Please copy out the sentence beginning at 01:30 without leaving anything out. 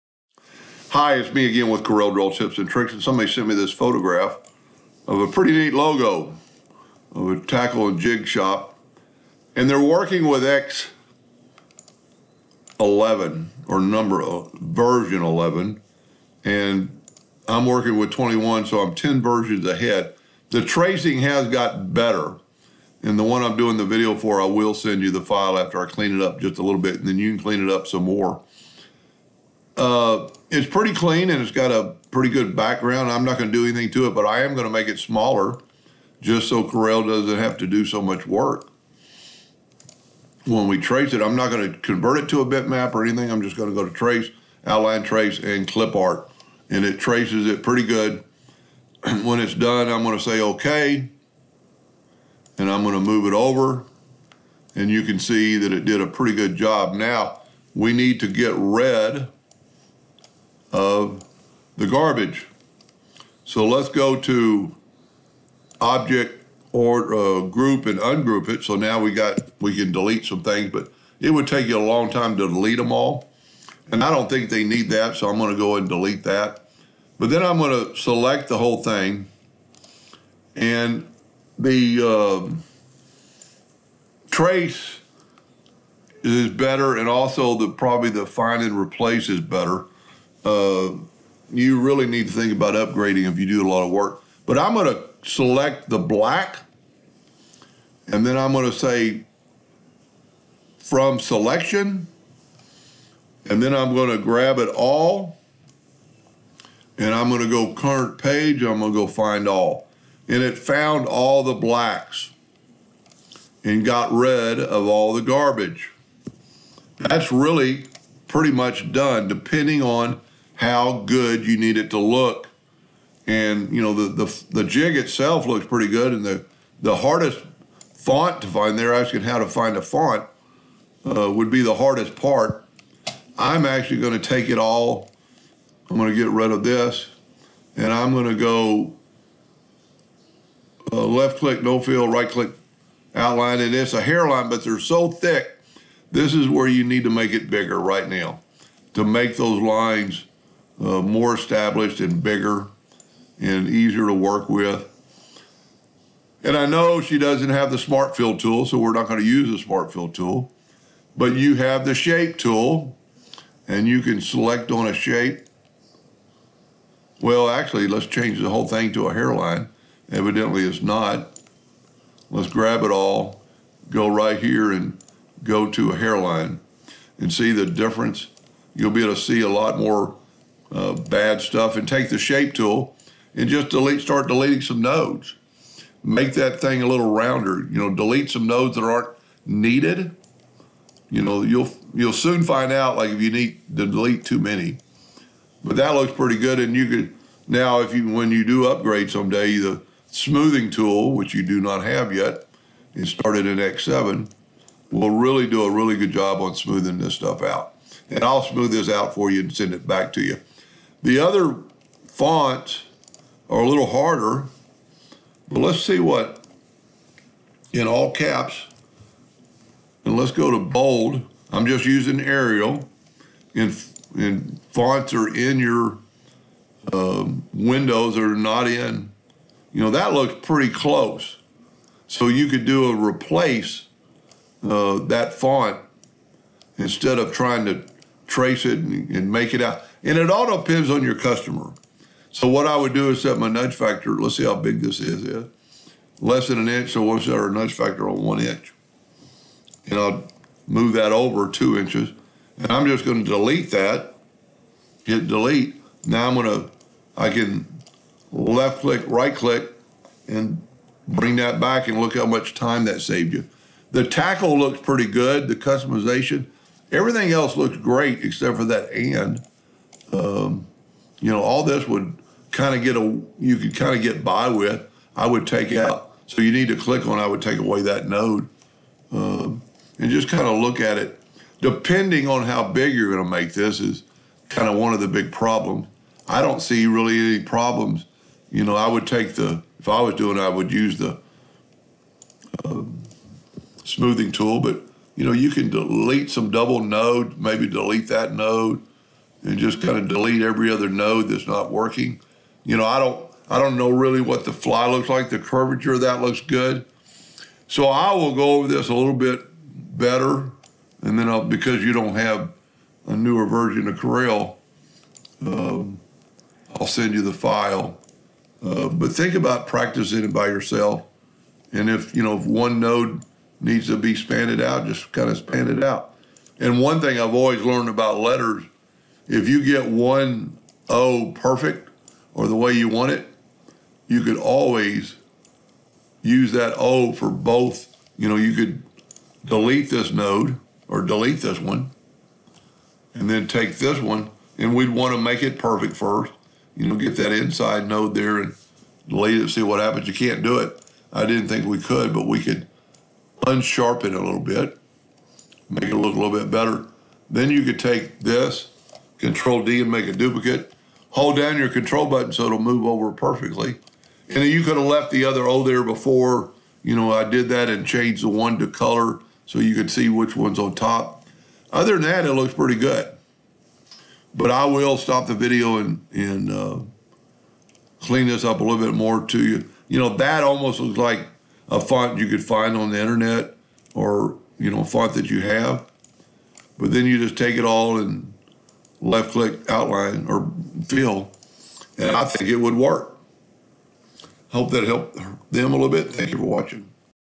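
Uh, you really need to think about upgrading if you do a lot of work.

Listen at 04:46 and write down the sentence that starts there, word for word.
I don't see really any problems.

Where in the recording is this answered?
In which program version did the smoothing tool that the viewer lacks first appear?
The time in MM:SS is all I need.
03:23.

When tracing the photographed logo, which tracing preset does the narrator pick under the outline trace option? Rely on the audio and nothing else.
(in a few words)
Clip art.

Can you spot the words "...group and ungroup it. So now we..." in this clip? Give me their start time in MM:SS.
01:07.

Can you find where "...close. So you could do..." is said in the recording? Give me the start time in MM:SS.
03:50.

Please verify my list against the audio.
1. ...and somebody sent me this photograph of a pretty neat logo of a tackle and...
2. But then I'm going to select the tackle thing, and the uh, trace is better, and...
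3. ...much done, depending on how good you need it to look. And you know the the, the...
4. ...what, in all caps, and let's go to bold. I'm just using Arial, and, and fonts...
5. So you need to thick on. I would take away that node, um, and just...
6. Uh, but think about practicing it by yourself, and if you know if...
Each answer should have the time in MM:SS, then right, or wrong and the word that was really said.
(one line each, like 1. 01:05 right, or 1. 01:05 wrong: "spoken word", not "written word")
1. 00:02 right
2. 01:17 wrong: "whole", not "tackle"
3. 01:58 right
4. 03:35 right
5. 04:36 wrong: "click", not "thick"
6. 05:18 right.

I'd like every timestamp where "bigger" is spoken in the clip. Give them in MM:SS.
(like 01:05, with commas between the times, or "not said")
02:27, 02:32.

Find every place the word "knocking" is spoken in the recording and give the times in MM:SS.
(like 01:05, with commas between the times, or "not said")
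not said.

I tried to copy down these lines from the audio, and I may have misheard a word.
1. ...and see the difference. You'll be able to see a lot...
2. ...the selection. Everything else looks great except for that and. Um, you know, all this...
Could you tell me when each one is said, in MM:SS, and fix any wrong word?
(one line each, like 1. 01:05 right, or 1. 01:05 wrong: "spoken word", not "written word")
1. 02:57 right
2. 04:25 wrong: "customization", not "selection".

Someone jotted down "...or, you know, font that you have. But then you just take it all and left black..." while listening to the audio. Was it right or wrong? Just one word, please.
wrong.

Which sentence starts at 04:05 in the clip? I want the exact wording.
Yeah, less than an inch, so we'll set our nudge factor on one inch.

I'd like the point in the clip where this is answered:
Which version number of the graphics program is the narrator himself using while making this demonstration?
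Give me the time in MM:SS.
00:17.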